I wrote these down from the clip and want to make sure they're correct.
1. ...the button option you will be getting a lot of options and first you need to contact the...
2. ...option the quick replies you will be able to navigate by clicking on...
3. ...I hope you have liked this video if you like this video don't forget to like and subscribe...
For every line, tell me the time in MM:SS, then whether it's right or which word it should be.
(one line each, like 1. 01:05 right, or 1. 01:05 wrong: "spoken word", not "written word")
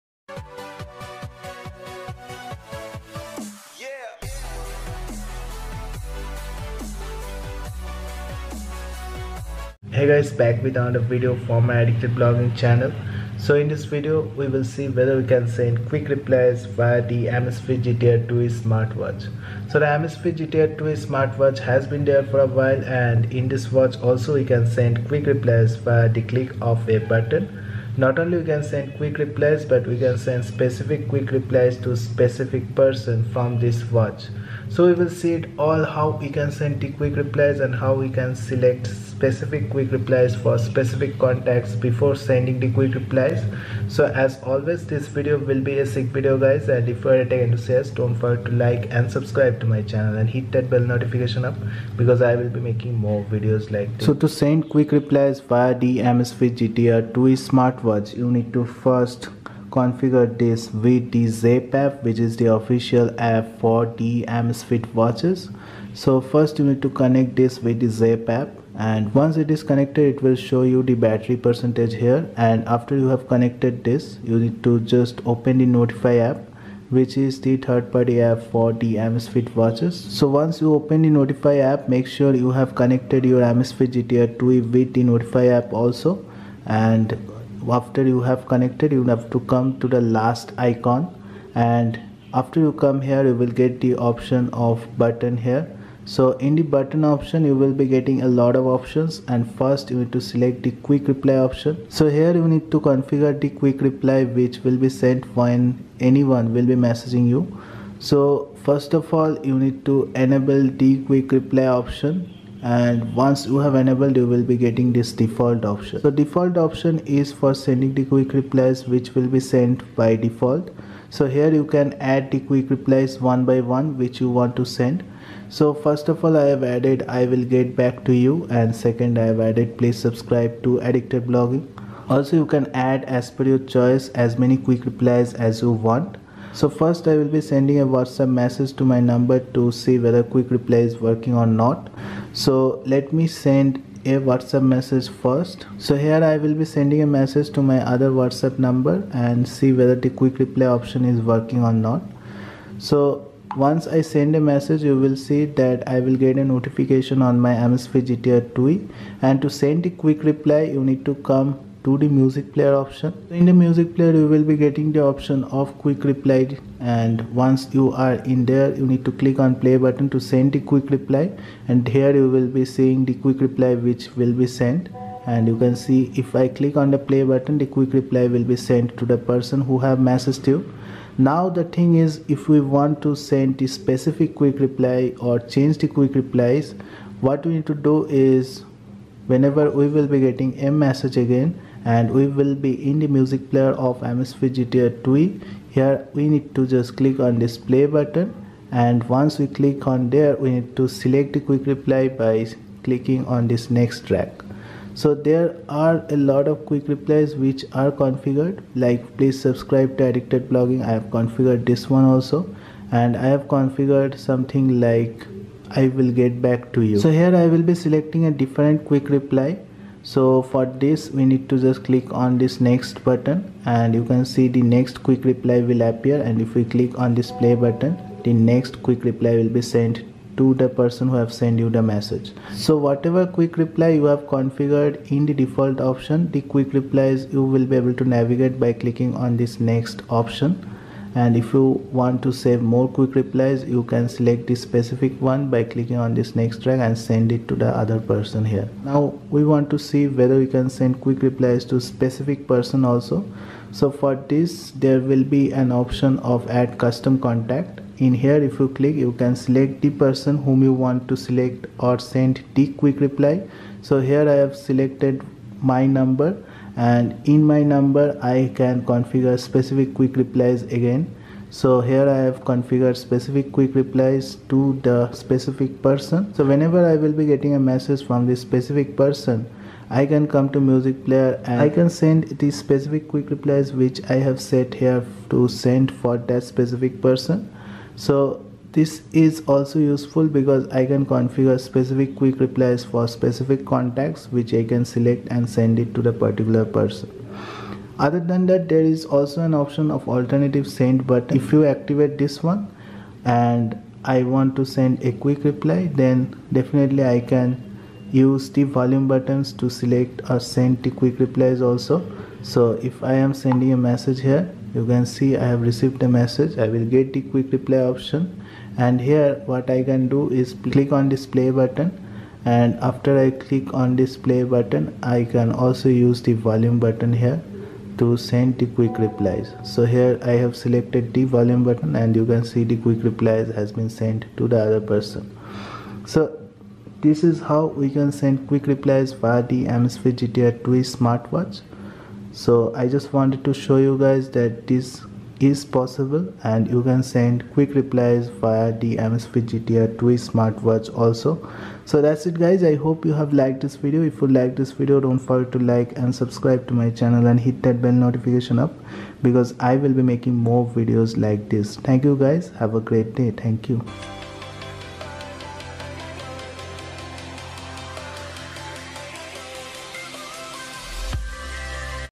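1. 01:36 wrong: "select", not "contact"
2. 03:55 right
3. 05:52 right.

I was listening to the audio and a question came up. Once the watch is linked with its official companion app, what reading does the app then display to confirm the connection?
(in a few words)
battery percentage.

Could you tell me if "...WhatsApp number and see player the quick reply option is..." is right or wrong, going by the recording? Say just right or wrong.
wrong.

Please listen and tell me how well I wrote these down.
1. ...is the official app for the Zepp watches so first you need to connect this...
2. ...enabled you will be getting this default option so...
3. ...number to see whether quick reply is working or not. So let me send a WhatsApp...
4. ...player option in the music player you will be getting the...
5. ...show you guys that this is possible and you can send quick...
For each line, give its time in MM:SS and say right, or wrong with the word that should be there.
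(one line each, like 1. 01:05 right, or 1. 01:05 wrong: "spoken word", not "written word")
1. 01:02 wrong: "Amazfit", not "Zepp"
2. 01:53 right
3. 02:18 right
4. 02:42 right
5. 05:43 right.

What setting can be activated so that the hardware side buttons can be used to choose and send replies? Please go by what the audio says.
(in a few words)
alternative send.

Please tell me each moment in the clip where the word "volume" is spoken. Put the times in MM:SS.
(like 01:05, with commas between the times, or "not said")
05:08, 05:26, 05:31.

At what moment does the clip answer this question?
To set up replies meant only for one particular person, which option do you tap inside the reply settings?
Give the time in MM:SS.
04:16.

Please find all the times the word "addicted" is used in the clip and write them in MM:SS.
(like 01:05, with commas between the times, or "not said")
00:11, 02:10, 03:30.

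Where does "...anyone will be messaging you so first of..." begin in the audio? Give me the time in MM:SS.
01:45.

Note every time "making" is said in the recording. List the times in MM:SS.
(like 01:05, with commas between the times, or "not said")
00:52, 06:00.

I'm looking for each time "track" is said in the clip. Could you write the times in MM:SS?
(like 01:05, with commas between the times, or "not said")
03:24, 04:06.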